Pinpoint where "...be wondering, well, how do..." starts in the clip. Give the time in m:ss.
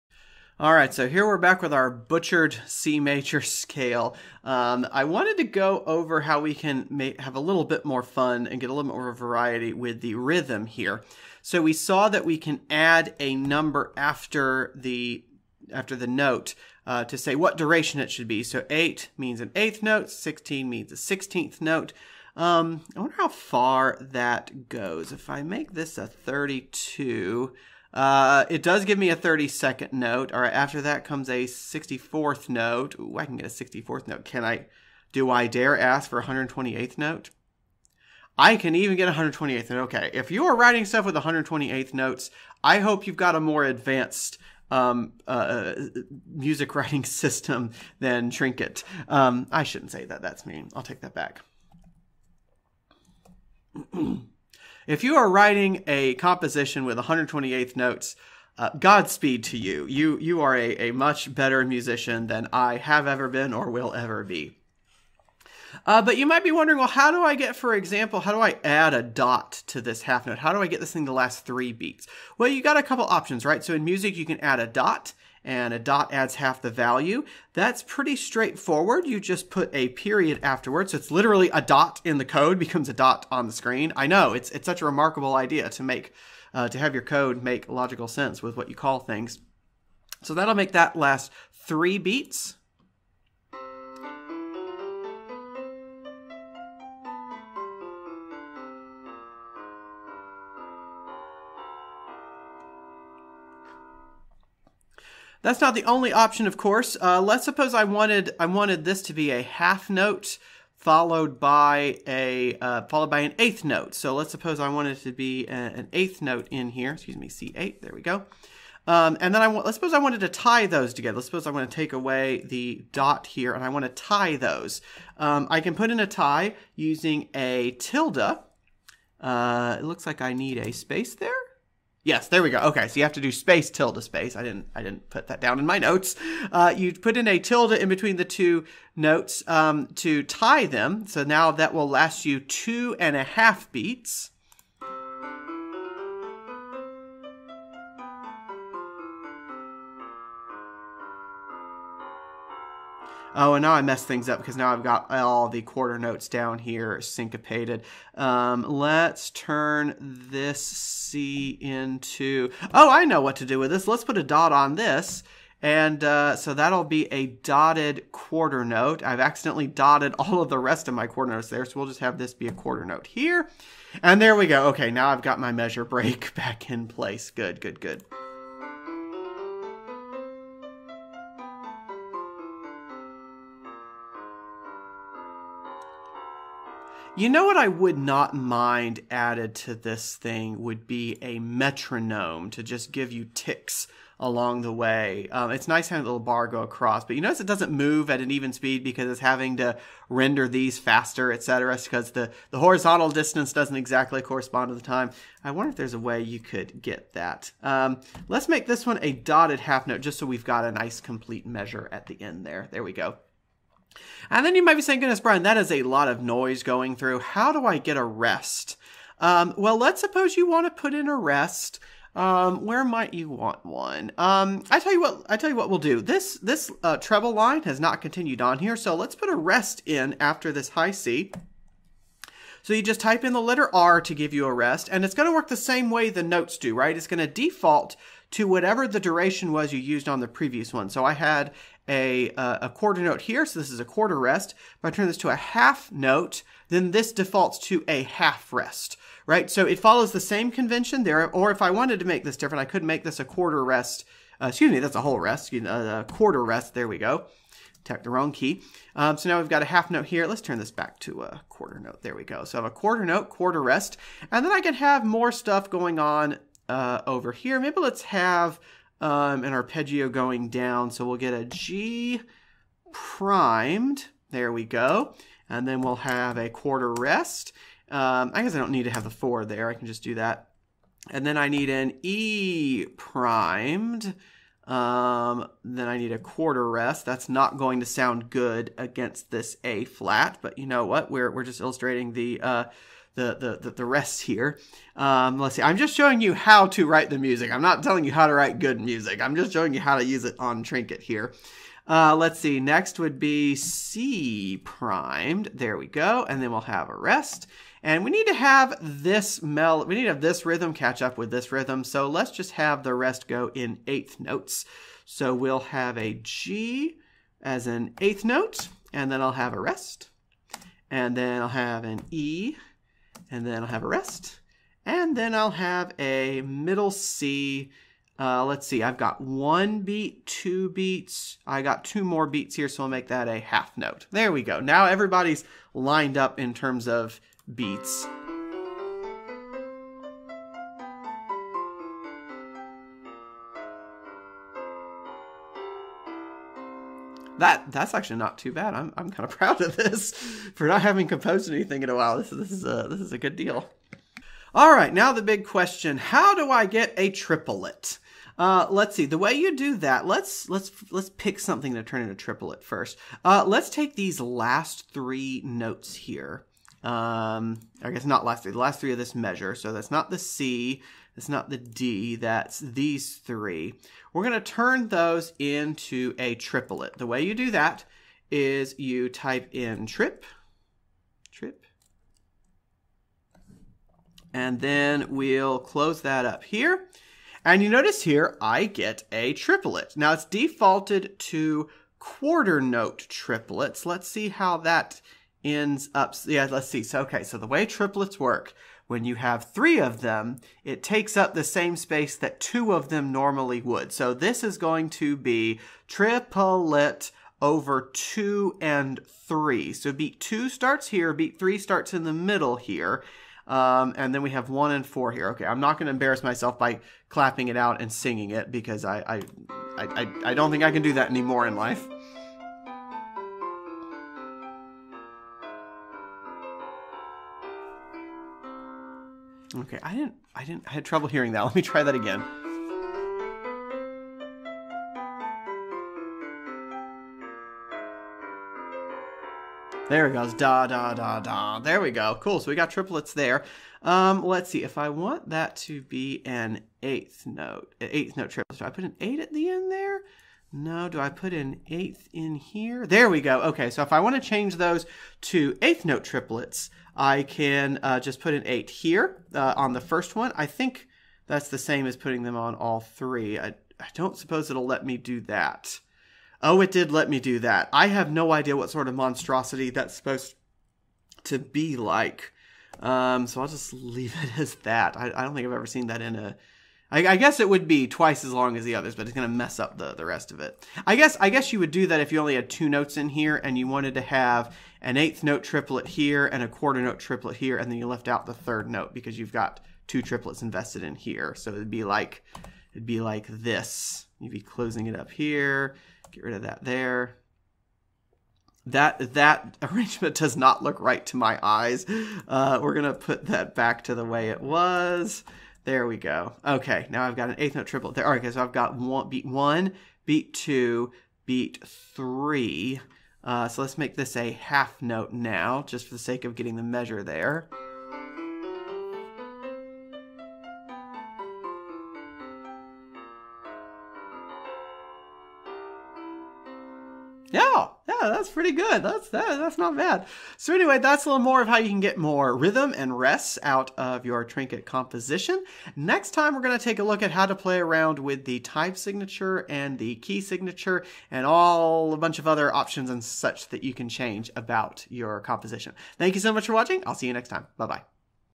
1:06.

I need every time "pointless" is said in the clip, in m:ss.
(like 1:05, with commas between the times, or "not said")
not said.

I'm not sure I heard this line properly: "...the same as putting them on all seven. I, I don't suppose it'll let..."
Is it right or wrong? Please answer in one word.
wrong.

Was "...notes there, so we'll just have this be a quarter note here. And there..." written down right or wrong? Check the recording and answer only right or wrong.
right.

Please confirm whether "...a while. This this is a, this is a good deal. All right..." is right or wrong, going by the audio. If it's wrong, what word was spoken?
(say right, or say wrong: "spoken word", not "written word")
right.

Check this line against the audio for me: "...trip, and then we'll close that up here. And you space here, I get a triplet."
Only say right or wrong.
wrong.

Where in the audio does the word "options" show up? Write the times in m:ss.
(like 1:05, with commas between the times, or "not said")
1:13, 1:46, 9:02.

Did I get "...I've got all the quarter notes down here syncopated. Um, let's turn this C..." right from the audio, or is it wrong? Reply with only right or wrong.
right.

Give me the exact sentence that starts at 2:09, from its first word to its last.
Uh, it looks like I need a space there.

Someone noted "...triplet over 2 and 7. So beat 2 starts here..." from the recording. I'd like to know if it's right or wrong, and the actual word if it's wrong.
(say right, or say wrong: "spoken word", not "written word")
wrong: "3", not "7".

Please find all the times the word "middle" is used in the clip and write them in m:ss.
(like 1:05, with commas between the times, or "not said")
5:26, 6:52.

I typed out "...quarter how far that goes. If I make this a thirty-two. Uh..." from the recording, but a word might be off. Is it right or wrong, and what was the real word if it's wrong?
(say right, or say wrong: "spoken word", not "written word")
wrong: "wonder", not "quarter".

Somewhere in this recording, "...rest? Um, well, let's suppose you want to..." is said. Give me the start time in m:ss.
3:38.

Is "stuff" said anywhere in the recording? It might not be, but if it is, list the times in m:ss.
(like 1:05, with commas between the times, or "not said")
0:40, 4:25.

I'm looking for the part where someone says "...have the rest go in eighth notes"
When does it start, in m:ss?
5:12.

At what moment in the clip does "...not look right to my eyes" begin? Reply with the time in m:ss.
8:20.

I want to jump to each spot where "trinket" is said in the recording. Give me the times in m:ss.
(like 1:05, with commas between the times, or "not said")
0:48, 5:00, 8:54.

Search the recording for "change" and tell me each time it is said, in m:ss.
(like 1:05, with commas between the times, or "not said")
7:34, 9:03.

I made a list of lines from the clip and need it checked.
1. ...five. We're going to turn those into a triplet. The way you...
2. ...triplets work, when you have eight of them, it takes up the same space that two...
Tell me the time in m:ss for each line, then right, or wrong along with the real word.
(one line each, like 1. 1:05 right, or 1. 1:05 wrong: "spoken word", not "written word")
1. 6:13 wrong: "three", not "five"
2. 6:37 wrong: "three", not "eight".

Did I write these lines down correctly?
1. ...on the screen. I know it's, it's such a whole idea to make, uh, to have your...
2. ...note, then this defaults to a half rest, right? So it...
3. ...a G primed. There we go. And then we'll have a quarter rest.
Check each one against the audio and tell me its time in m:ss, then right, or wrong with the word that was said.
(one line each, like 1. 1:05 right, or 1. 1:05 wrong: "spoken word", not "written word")
1. 1:23 wrong: "remarkable", not "whole"
2. 4:05 right
3. 4:31 right.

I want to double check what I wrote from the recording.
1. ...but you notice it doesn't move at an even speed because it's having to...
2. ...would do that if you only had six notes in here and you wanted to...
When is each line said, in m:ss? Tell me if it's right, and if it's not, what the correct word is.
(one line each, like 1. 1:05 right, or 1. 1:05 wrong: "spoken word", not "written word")
1. 3:17 right
2. 8:01 wrong: "two", not "six".